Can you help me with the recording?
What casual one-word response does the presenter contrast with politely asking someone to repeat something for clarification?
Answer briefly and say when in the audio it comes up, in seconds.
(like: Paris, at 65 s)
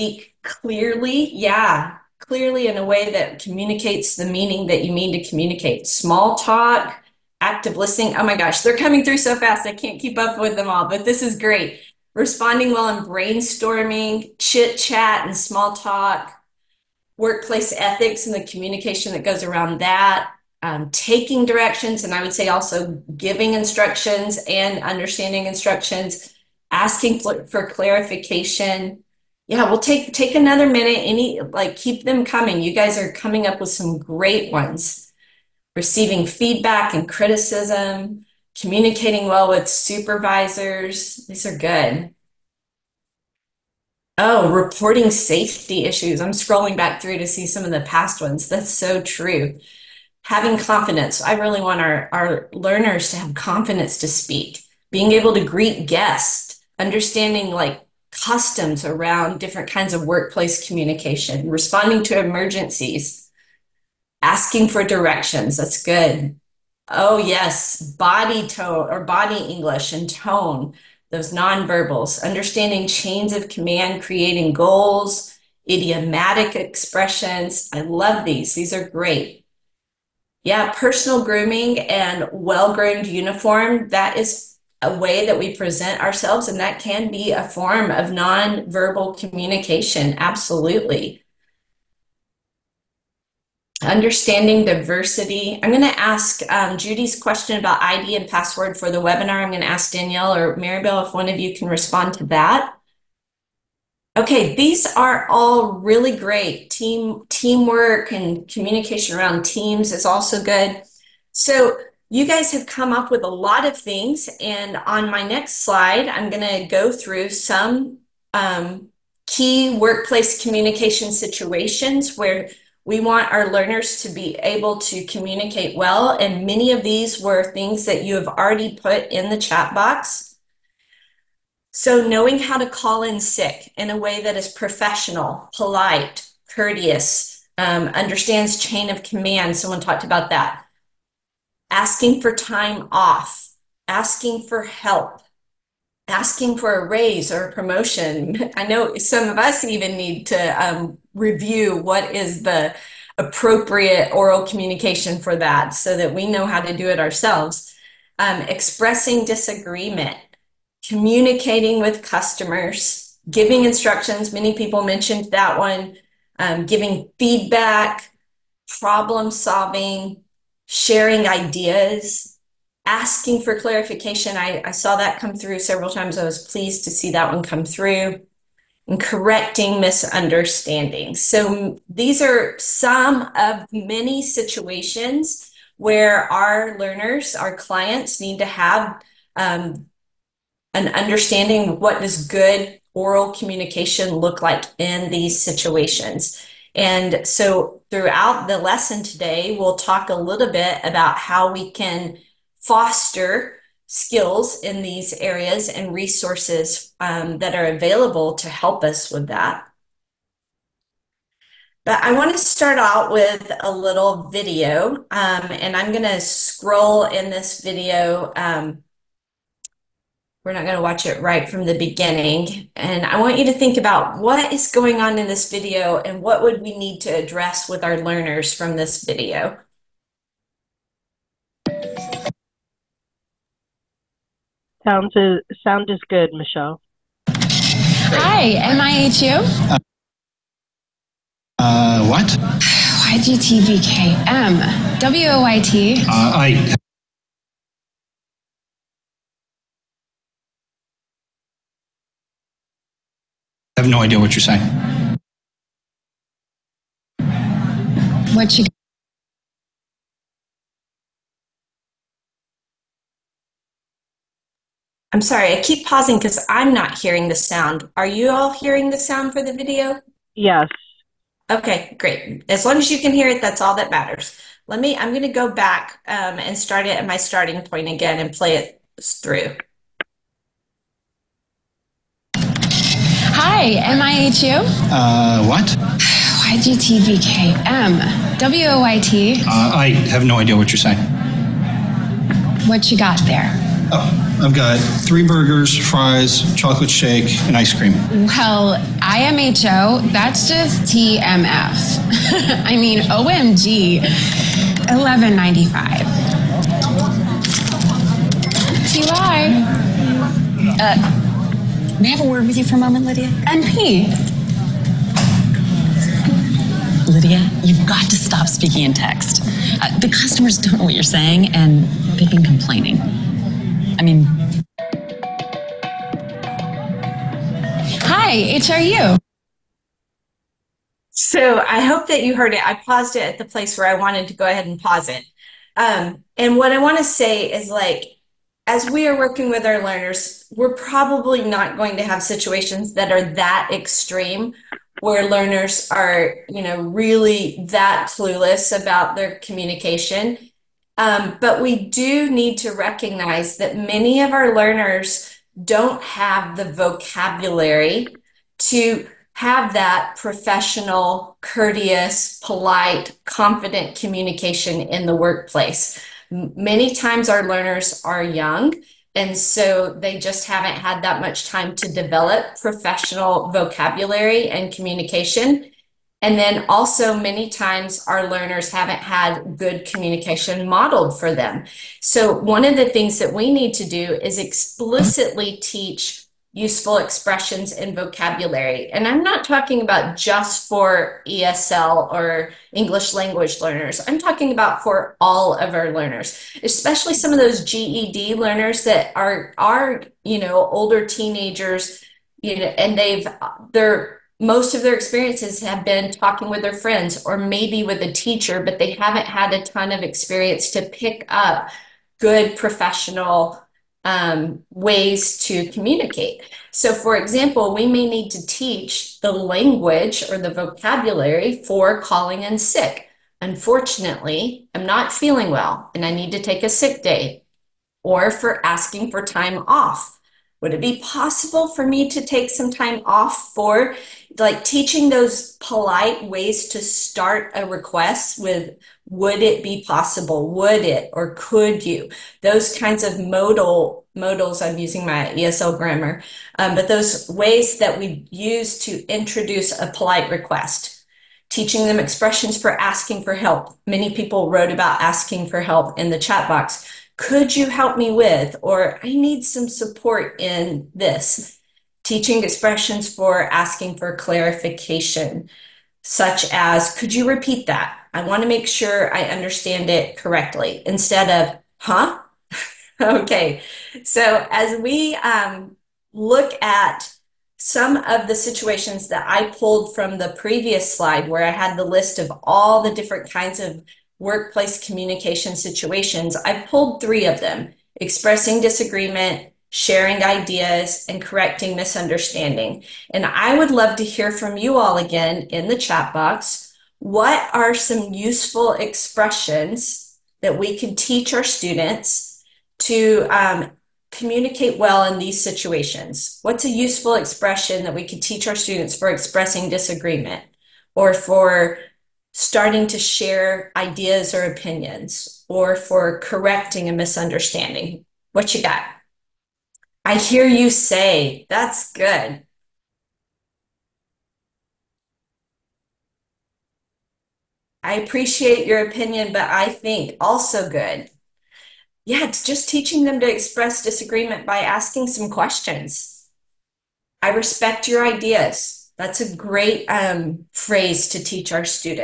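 huh, at 471 s.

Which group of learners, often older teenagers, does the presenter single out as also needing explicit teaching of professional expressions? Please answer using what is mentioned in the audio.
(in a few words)
GED learners.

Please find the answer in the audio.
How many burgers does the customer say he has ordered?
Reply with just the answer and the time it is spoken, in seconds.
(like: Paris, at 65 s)
3, at 295 s.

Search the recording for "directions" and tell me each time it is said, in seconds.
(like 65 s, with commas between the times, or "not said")
21 s, 64 s.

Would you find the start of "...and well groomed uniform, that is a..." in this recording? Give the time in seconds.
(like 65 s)
81 s.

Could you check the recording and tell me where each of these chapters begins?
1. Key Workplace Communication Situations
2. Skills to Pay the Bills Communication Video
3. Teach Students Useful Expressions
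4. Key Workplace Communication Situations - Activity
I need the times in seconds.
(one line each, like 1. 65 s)
1. 129 s
2. 212 s
3. 385 s
4. 475 s.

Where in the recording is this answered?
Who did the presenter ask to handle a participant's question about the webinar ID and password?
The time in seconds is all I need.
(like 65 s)
99 s.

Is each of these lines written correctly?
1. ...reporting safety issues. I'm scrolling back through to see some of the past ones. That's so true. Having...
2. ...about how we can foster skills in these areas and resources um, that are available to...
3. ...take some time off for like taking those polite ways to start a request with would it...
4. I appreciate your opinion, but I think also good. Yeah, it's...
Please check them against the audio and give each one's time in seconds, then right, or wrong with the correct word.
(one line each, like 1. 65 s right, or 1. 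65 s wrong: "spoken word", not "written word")
1. 44 s right
2. 200 s right
3. 432 s wrong: "teaching", not "taking"
4. 527 s right.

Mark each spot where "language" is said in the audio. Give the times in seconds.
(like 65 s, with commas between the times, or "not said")
393 s, 419 s.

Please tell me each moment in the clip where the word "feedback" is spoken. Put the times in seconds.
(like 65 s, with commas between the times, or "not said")
36 s, 167 s.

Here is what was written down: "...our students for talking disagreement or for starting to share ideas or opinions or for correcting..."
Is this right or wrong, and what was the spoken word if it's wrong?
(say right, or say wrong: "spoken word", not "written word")
wrong: "expressing", not "talking".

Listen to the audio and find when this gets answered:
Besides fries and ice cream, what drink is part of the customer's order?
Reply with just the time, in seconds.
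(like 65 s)
296 s.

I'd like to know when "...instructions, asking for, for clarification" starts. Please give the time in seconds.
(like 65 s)
25 s.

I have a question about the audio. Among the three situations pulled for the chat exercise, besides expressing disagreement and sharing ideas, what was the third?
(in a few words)
correcting misunderstanding.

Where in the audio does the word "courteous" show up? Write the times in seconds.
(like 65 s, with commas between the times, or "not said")
136 s, 361 s.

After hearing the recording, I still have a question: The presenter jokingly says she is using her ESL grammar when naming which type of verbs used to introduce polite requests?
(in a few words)
modals.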